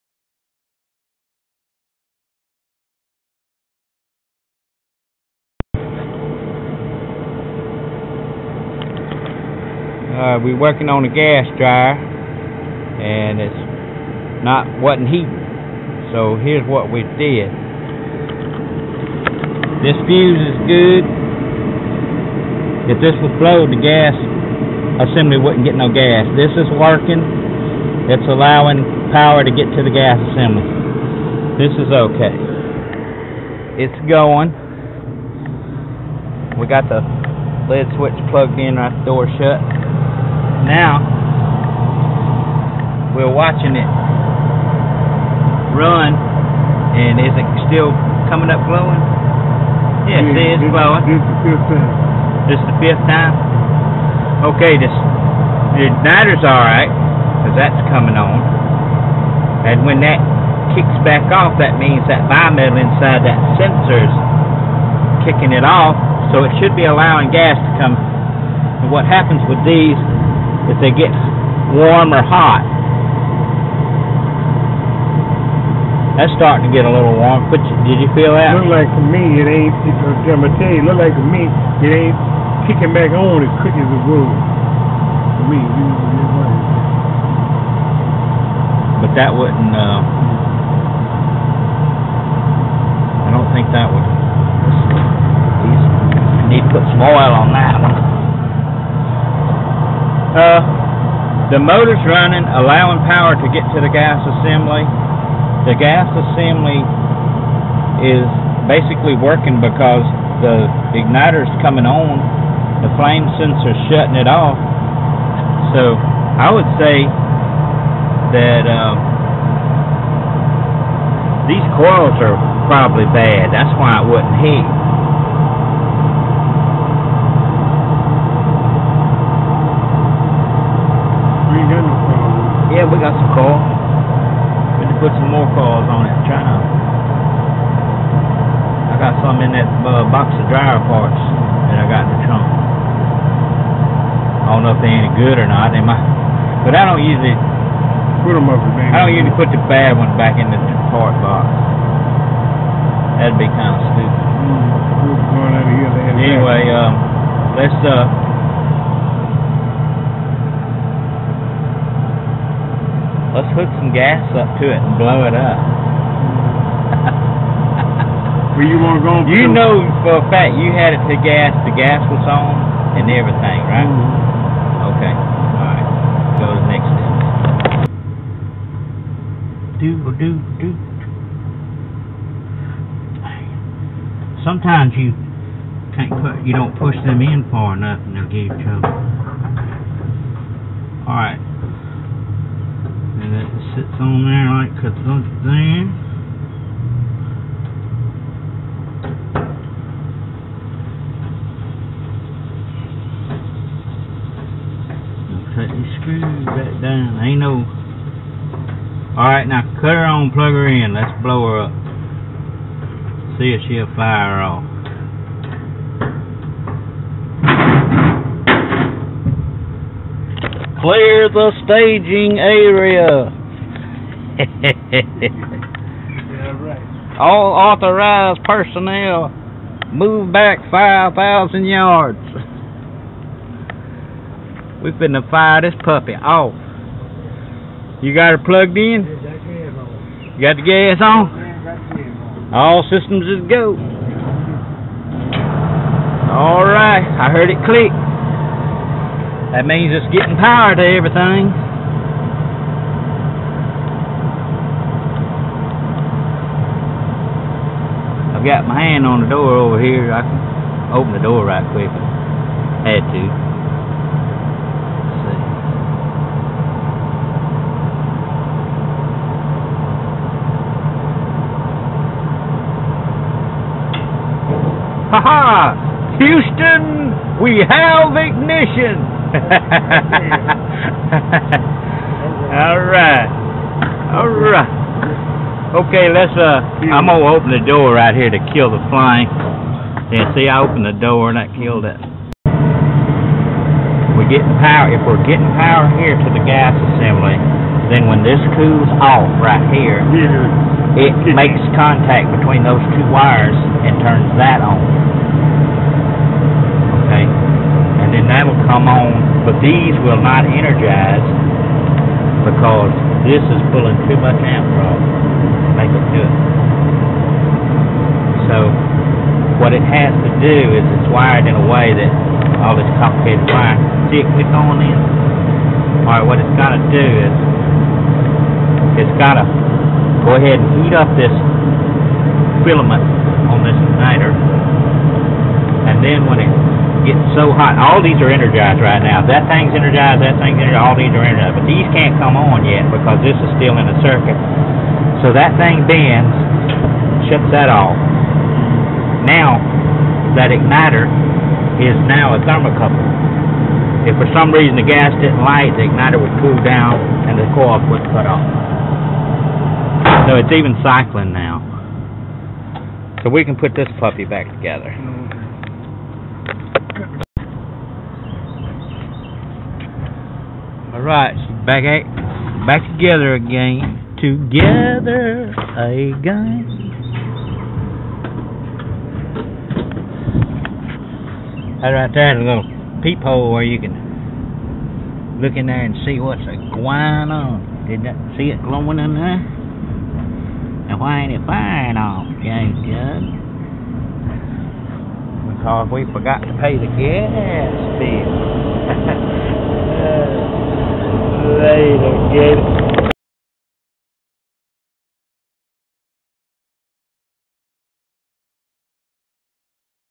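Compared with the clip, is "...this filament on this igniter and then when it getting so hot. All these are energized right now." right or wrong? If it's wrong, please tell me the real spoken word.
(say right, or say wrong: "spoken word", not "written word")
right.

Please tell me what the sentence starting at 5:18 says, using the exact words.
So what it has to do is it's wired in a way that all this complicated wire.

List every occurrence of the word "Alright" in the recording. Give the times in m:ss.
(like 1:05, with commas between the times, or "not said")
3:29, 4:06, 5:26, 6:11.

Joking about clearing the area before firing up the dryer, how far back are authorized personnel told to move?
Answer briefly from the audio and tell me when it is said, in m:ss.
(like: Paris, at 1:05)
5,000 yards, at 3:50.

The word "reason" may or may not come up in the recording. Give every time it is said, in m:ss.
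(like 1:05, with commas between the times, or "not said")
5:54.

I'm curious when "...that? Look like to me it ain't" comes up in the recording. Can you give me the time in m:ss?
1:18.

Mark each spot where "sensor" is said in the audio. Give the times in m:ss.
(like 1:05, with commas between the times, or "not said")
1:03, 1:53.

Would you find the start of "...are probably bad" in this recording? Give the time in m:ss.
2:02.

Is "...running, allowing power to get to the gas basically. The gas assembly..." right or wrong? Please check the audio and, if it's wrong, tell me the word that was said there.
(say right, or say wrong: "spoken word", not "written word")
wrong: "assembly", not "basically".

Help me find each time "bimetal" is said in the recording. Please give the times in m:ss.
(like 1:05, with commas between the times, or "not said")
1:02.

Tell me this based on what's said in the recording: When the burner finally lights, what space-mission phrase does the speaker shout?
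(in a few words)
Houston, we have ignition.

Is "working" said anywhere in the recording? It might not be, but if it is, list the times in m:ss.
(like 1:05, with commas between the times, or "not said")
0:10, 0:26, 1:49.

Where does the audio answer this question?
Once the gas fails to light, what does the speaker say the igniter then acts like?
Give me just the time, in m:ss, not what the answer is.
5:52.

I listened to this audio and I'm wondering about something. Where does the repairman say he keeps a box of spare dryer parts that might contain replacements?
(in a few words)
in the trunk.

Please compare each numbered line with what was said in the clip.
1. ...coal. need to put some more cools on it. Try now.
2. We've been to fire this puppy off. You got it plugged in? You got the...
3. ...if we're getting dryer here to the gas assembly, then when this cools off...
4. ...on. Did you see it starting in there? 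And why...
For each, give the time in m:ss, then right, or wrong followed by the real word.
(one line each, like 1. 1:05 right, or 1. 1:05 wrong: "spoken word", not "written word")
1. 2:13 wrong: "coals", not "cools"
2. 3:54 right
3. 4:54 wrong: "power", not "dryer"
4. 6:27 wrong: "glowing", not "starting".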